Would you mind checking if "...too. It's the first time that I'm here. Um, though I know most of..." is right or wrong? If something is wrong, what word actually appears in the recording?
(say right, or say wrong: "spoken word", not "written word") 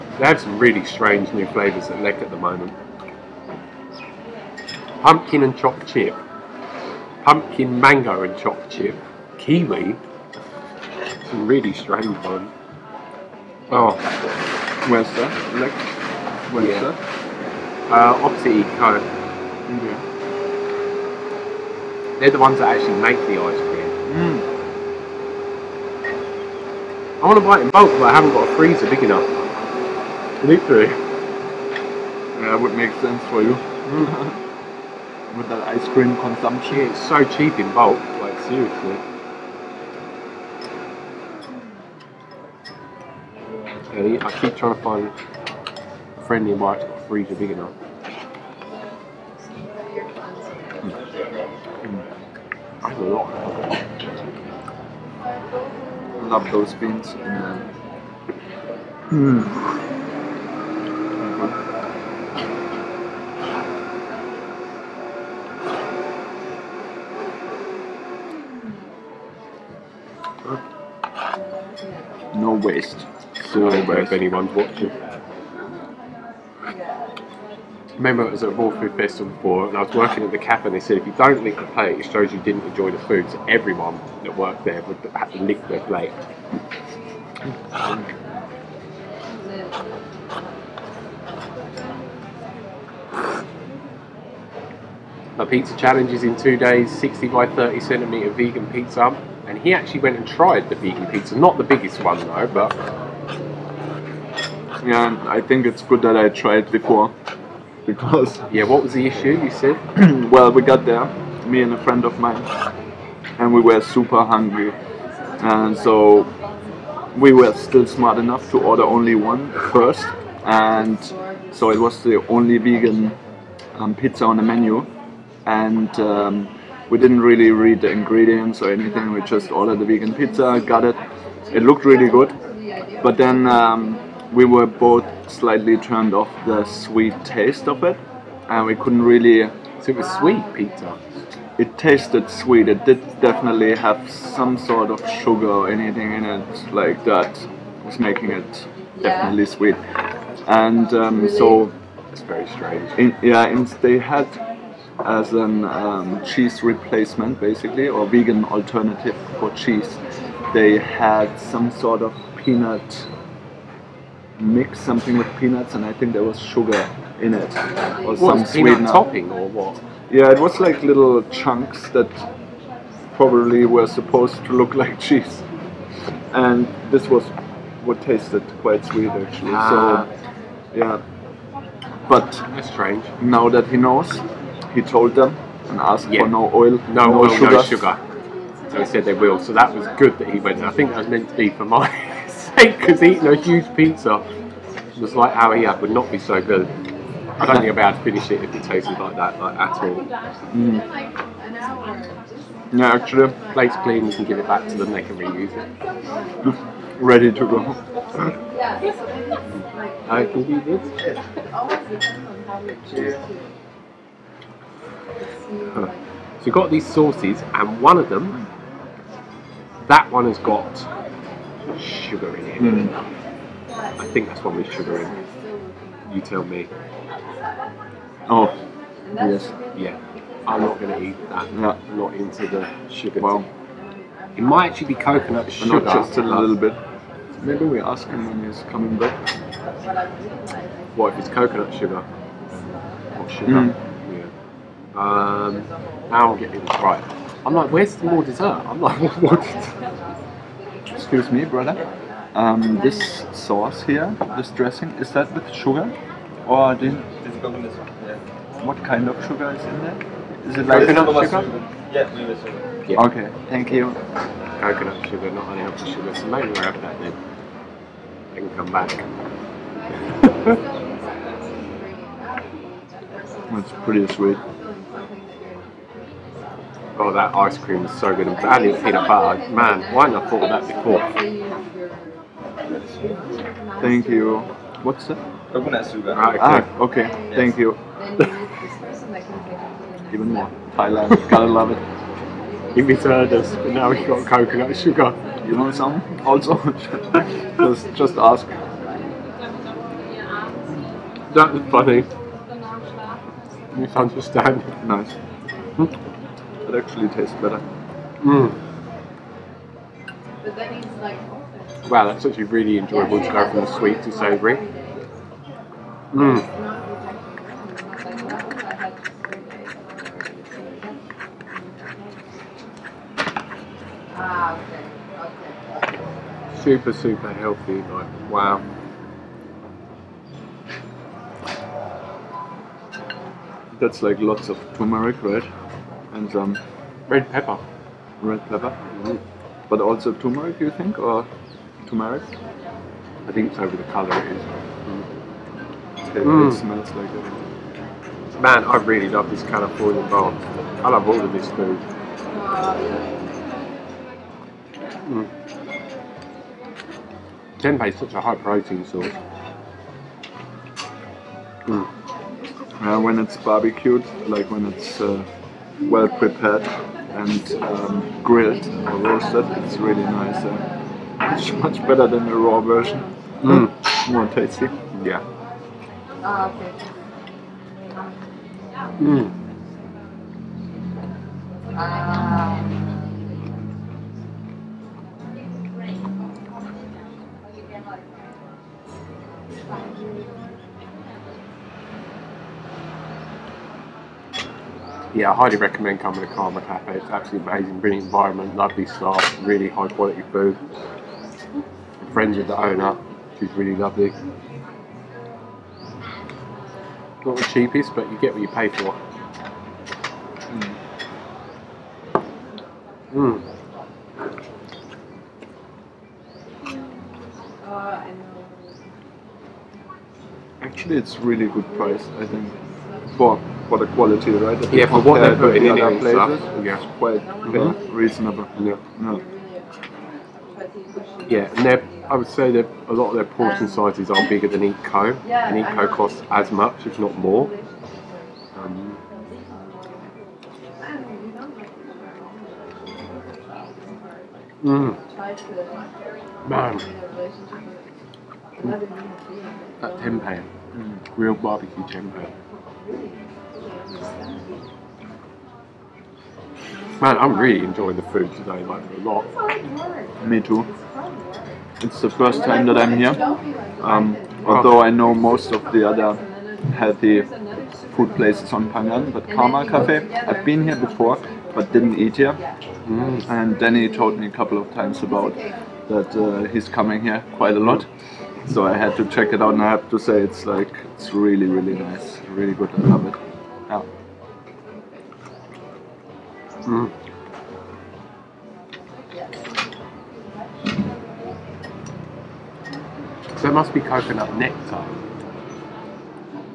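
wrong: "although", not "though".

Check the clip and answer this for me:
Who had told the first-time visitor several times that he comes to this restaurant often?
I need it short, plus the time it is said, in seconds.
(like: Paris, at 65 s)
Danny, at 473 s.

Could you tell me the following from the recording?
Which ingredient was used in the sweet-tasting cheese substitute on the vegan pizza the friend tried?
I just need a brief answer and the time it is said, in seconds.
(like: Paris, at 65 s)
Peanuts, at 165 s.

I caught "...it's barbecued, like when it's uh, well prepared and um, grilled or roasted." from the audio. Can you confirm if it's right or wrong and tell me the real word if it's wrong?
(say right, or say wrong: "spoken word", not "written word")
right.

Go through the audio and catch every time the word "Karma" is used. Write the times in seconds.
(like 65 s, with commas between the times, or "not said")
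396 s, 469 s.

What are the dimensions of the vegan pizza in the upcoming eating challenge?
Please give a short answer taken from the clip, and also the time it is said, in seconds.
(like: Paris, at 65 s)
60 by 30 centimetres, at 96 s.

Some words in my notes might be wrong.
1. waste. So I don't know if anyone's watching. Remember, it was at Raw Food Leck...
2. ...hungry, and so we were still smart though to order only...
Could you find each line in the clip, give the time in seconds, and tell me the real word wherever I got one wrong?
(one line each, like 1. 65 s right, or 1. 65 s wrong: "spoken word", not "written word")
1. 72 s wrong: "Festival", not "Leck"
2. 114 s wrong: "enough", not "though".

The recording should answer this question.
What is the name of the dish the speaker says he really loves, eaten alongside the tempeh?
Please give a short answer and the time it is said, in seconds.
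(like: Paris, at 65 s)
Californian bowl, at 349 s.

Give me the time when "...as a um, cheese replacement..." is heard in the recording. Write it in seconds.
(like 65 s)
155 s.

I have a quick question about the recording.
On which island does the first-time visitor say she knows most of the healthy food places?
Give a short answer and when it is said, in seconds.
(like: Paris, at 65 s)
Phangan, at 468 s.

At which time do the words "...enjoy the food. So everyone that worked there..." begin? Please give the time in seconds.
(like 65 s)
82 s.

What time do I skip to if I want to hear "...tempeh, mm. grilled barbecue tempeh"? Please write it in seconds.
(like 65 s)
449 s.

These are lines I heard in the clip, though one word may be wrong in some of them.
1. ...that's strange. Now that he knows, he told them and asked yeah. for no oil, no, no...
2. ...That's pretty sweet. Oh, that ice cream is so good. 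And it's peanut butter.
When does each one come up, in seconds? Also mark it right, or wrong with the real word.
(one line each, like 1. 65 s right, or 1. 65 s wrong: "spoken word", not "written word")
1. 182 s right
2. 273 s right.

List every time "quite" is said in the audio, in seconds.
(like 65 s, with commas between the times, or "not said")
178 s, 426 s, 477 s.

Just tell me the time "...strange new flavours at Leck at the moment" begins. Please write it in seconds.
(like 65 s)
0 s.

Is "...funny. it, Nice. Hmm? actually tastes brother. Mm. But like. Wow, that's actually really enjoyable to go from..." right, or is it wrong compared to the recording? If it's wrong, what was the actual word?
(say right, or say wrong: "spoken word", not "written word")
wrong: "better", not "brother".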